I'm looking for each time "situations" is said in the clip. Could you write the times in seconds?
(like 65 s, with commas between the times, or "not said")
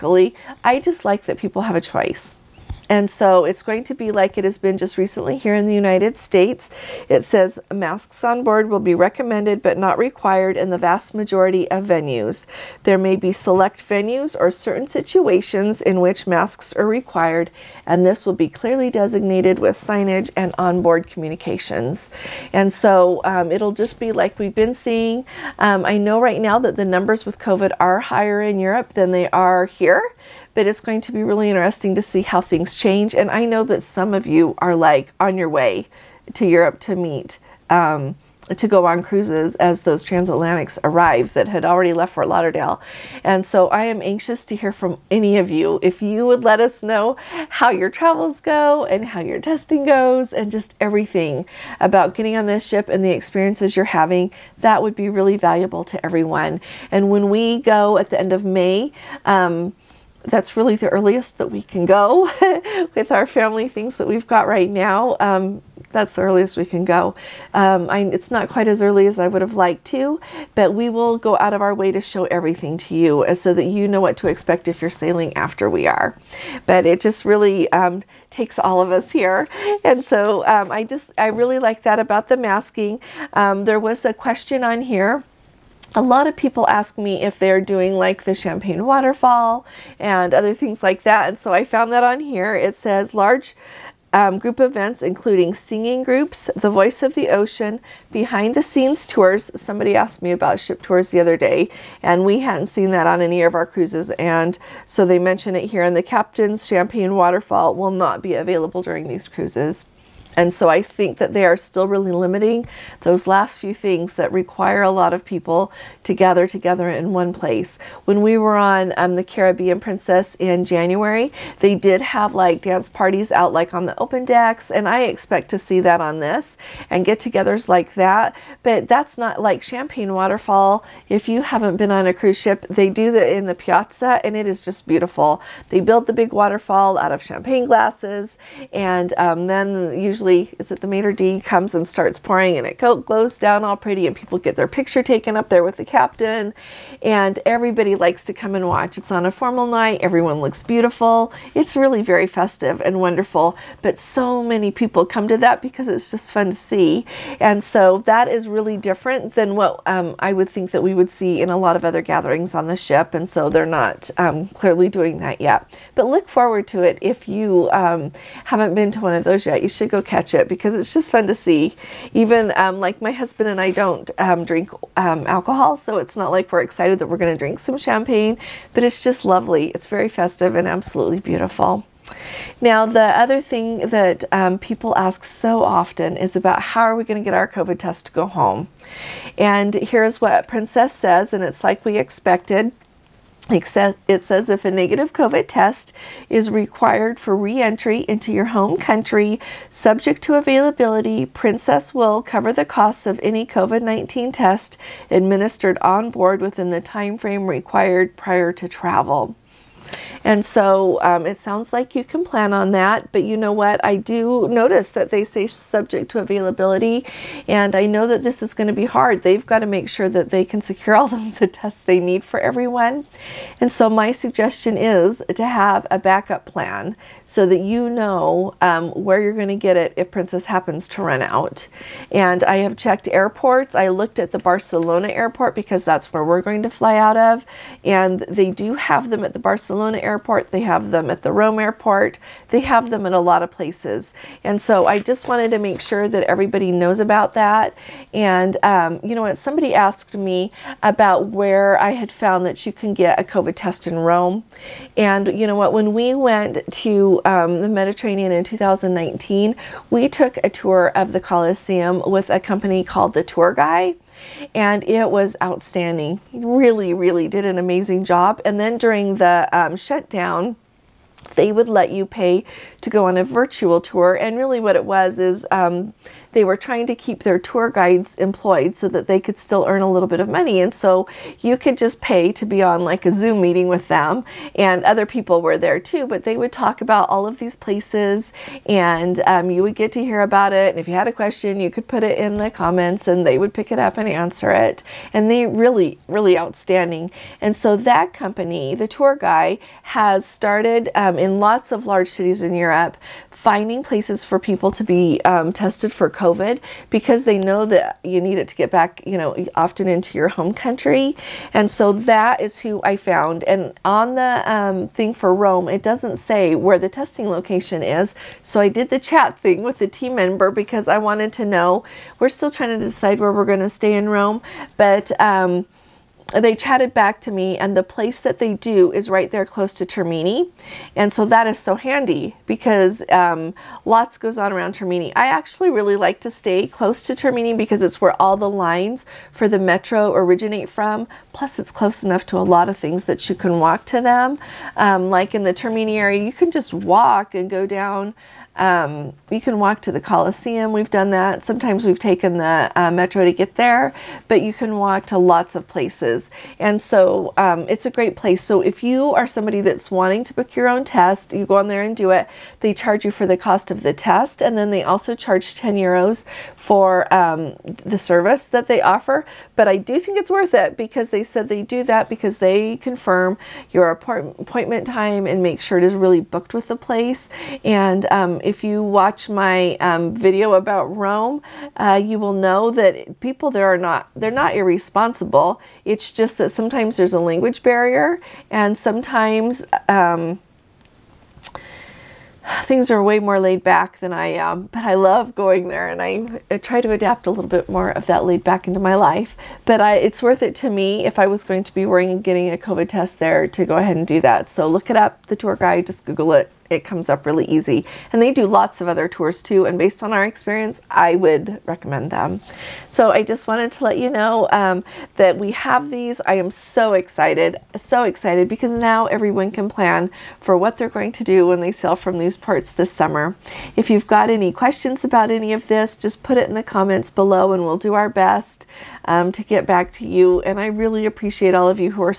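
14 s.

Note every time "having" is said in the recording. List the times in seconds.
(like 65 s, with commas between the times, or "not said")
53 s.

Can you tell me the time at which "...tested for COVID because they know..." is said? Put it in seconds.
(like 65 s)
305 s.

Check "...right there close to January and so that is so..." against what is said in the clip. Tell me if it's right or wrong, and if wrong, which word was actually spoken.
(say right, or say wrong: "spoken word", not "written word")
wrong: "Termini", not "January".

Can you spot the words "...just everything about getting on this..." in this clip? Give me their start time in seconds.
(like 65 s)
50 s.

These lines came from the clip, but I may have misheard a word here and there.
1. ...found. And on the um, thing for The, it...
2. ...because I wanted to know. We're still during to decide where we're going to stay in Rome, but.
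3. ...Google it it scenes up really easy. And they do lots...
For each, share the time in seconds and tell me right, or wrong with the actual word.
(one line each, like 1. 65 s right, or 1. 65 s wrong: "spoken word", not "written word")
1. 312 s wrong: "Rome", not "The"
2. 320 s wrong: "trying", not "during"
3. 406 s wrong: "comes", not "scenes".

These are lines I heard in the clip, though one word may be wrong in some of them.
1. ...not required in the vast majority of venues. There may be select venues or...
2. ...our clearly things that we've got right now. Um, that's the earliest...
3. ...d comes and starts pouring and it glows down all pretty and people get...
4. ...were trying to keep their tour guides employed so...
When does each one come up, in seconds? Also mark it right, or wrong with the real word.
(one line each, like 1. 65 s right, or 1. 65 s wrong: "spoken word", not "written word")
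1. 9 s right
2. 63 s wrong: "family", not "clearly"
3. 141 s right
4. 276 s right.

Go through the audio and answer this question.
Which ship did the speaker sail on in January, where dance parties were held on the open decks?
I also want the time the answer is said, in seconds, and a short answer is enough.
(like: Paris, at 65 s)
Caribbean Princess, at 119 s.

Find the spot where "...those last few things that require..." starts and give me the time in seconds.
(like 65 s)
113 s.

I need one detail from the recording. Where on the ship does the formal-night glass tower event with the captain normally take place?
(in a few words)
the piazza.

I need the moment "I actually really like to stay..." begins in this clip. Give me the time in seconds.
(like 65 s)
335 s.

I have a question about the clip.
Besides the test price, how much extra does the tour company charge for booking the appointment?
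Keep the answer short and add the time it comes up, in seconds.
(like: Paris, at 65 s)
10 euros, at 365 s.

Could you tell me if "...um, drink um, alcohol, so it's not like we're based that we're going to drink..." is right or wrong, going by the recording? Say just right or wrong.
wrong.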